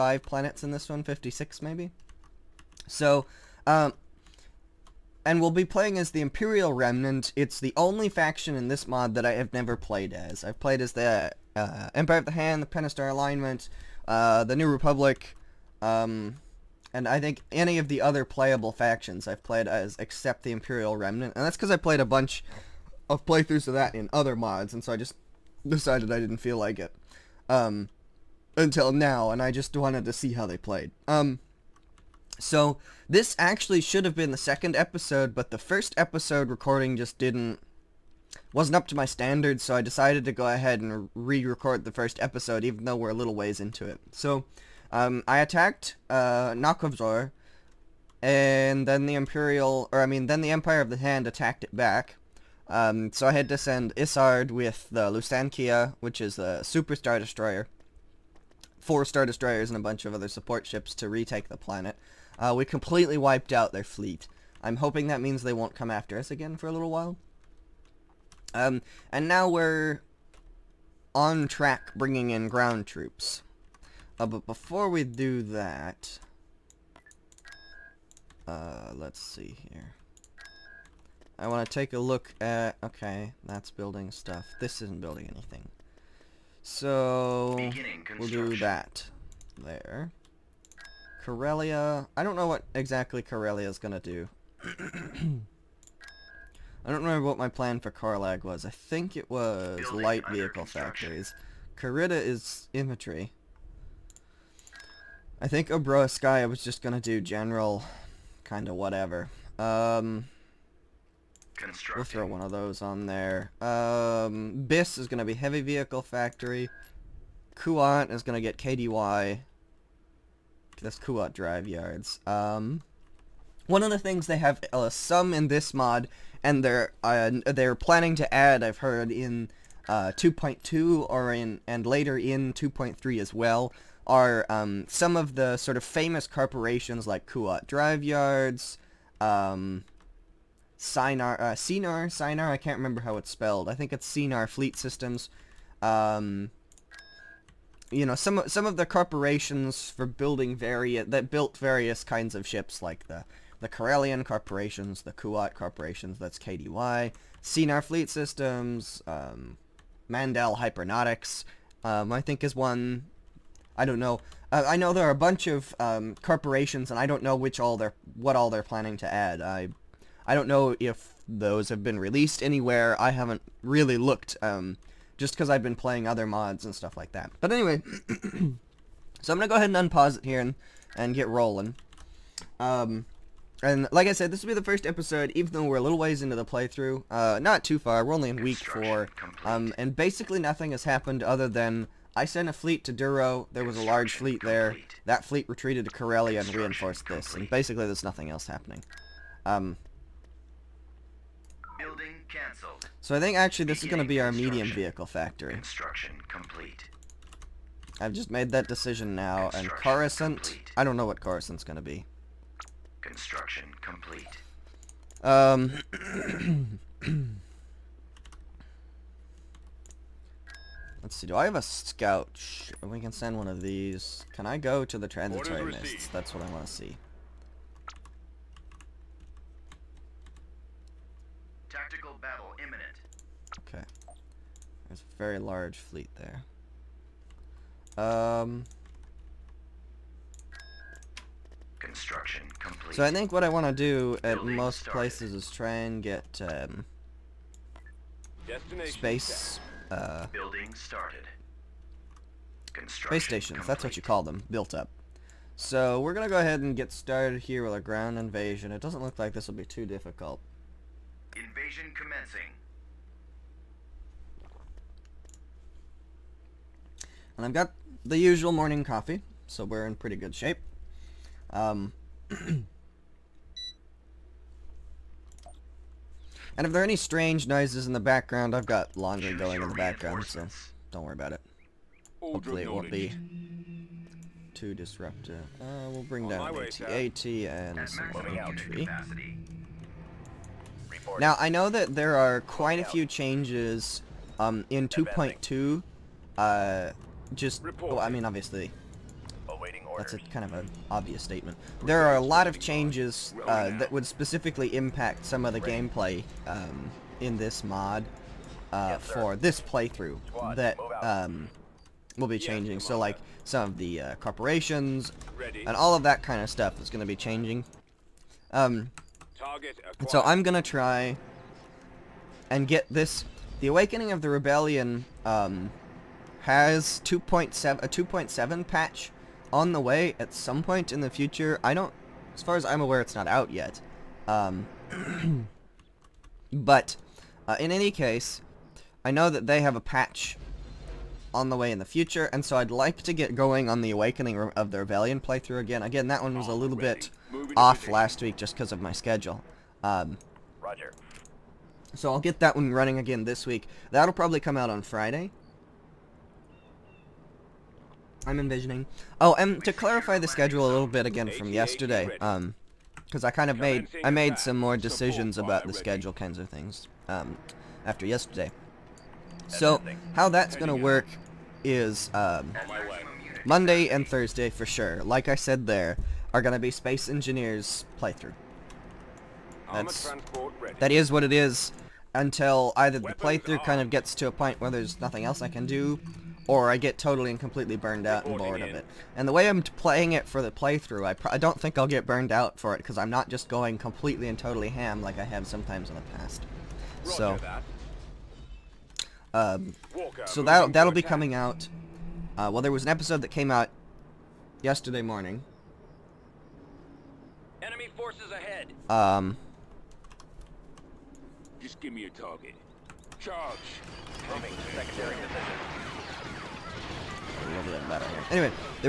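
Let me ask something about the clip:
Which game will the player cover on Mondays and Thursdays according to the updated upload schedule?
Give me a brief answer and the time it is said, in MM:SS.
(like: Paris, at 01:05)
Space Engineers, at 06:16.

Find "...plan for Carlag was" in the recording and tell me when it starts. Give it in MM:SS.
01:37.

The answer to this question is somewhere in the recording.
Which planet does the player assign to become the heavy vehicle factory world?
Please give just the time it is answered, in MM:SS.
01:54.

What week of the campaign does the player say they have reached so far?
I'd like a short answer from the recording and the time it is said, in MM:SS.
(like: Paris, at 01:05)
4, at 03:08.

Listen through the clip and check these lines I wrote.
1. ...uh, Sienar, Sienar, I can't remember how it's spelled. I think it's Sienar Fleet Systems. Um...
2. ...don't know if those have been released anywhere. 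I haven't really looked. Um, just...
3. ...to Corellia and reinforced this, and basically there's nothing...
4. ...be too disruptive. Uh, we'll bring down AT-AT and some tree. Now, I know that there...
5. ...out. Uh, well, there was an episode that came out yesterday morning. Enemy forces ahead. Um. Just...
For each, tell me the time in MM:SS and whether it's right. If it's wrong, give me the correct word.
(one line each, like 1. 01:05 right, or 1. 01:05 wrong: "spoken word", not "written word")
1. 02:21 right
2. 02:50 right
3. 03:15 right
4. 04:42 right
5. 06:41 right.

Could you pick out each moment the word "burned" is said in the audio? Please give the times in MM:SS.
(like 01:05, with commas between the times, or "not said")
06:27, 06:32.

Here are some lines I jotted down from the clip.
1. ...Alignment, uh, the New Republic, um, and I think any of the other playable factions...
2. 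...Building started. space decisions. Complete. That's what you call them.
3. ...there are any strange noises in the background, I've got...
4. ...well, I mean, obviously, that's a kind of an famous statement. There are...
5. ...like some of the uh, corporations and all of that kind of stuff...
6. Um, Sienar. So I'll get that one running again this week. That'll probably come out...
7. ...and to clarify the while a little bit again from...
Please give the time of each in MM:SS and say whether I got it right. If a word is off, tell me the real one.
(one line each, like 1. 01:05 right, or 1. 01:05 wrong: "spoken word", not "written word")
1. 00:13 right
2. 04:10 wrong: "stations", not "decisions"
3. 04:36 right
4. 04:57 wrong: "obvious", not "famous"
5. 05:12 right
6. 05:49 wrong: "Roger", not "Sienar"
7. 05:59 wrong: "schedule", not "while".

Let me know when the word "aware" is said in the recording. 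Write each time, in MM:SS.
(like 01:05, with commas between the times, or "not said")
05:32.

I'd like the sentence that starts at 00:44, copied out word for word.
So um, I attacked uh, Nakovzor, and then the Imperial, or I mean, then the Empire of the Hand attacked it back.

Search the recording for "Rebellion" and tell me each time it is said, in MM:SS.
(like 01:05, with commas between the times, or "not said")
05:24, 05:44.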